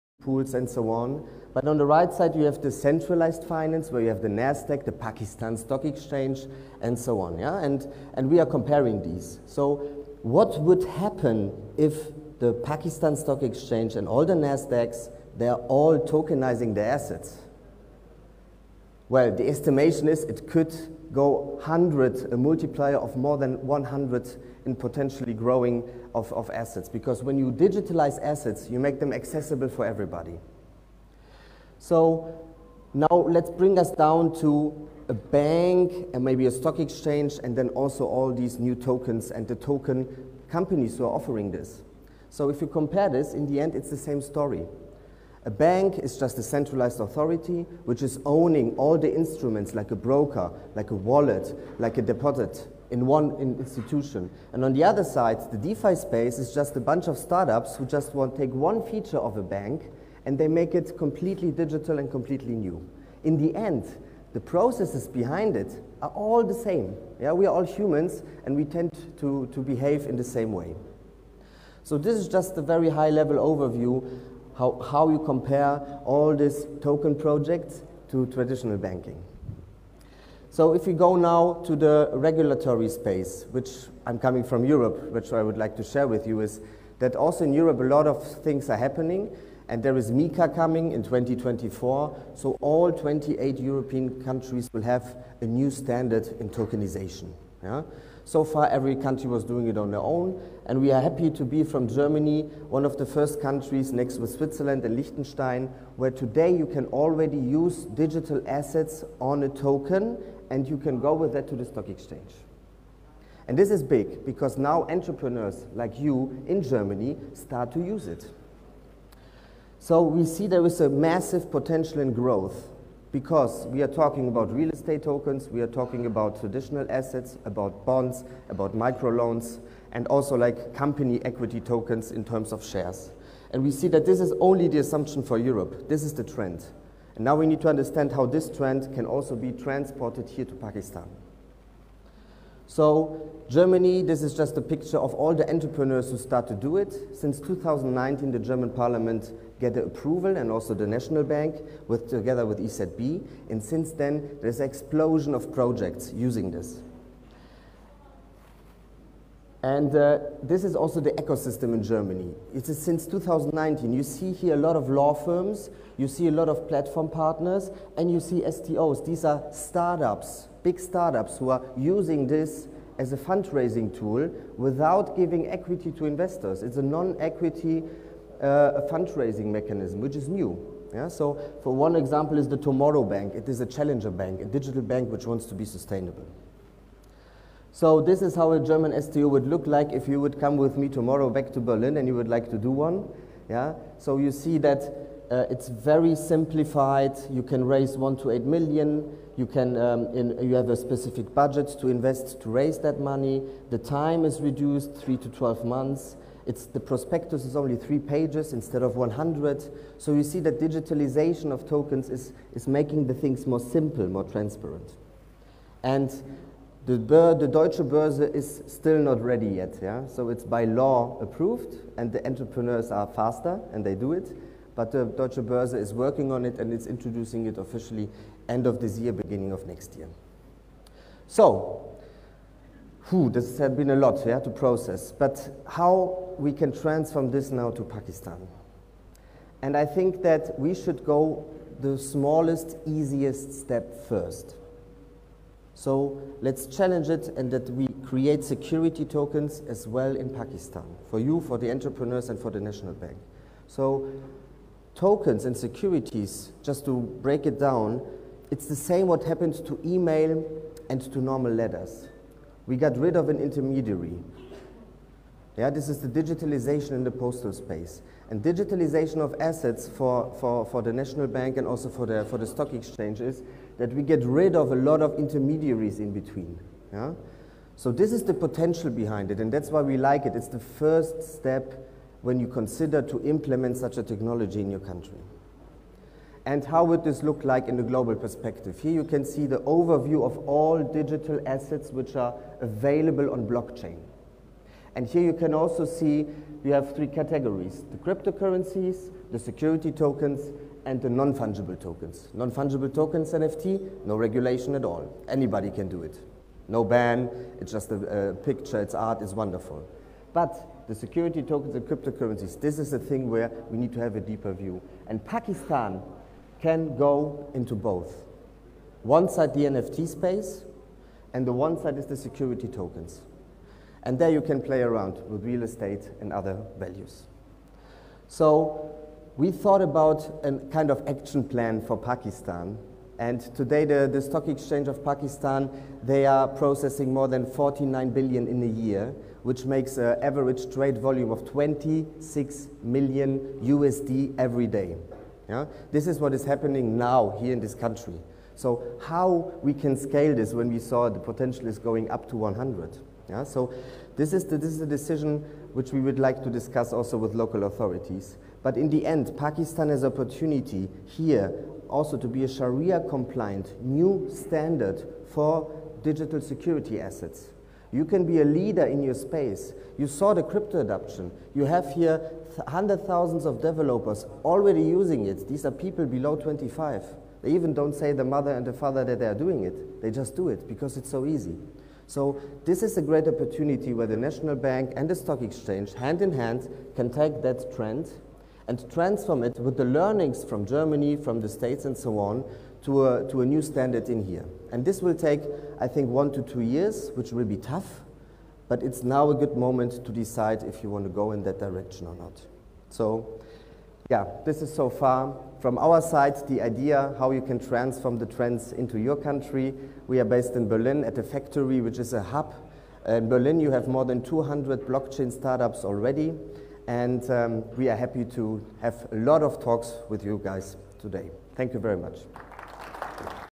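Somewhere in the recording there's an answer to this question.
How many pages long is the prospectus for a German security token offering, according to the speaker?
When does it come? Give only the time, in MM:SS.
03:27.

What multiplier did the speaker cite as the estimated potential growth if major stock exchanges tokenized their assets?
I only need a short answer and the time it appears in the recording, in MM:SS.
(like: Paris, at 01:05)
100, at 00:22.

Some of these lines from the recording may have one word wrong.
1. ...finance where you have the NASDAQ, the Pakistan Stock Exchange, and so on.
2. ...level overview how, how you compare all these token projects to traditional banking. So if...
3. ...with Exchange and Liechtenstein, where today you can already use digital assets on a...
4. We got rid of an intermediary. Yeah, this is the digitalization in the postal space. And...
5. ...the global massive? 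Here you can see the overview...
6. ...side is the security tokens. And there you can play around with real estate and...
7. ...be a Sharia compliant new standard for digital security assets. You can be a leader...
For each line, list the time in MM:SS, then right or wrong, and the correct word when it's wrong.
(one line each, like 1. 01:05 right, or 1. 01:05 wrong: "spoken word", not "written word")
1. 00:03 right
2. 01:13 right
3. 01:44 wrong: "Switzerland", not "Exchange"
4. 04:22 right
5. 04:47 wrong: "perspective", not "massive"
6. 05:21 right
7. 06:02 right.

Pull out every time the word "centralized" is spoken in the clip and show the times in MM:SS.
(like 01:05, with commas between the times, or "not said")
00:02, 00:46.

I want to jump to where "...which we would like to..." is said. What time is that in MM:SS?
05:55.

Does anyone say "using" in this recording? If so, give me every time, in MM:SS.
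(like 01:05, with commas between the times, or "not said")
02:36, 02:51, 06:14.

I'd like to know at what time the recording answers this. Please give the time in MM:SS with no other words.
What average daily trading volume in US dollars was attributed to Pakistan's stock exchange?
05:41.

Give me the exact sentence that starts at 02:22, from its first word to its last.
So Germany, this is just a picture of all the entrepreneurs who start to do it.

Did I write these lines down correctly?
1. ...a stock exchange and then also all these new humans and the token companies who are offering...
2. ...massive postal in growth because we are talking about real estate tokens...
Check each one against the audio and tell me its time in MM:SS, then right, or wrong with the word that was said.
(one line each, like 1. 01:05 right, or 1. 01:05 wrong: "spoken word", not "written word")
1. 00:36 wrong: "tokens", not "humans"
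2. 02:00 wrong: "potential", not "postal".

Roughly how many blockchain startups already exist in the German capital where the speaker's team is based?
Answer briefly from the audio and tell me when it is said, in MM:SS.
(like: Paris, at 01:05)
more than 200, at 06:53.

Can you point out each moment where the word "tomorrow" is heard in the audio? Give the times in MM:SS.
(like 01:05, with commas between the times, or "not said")
03:02, 03:10.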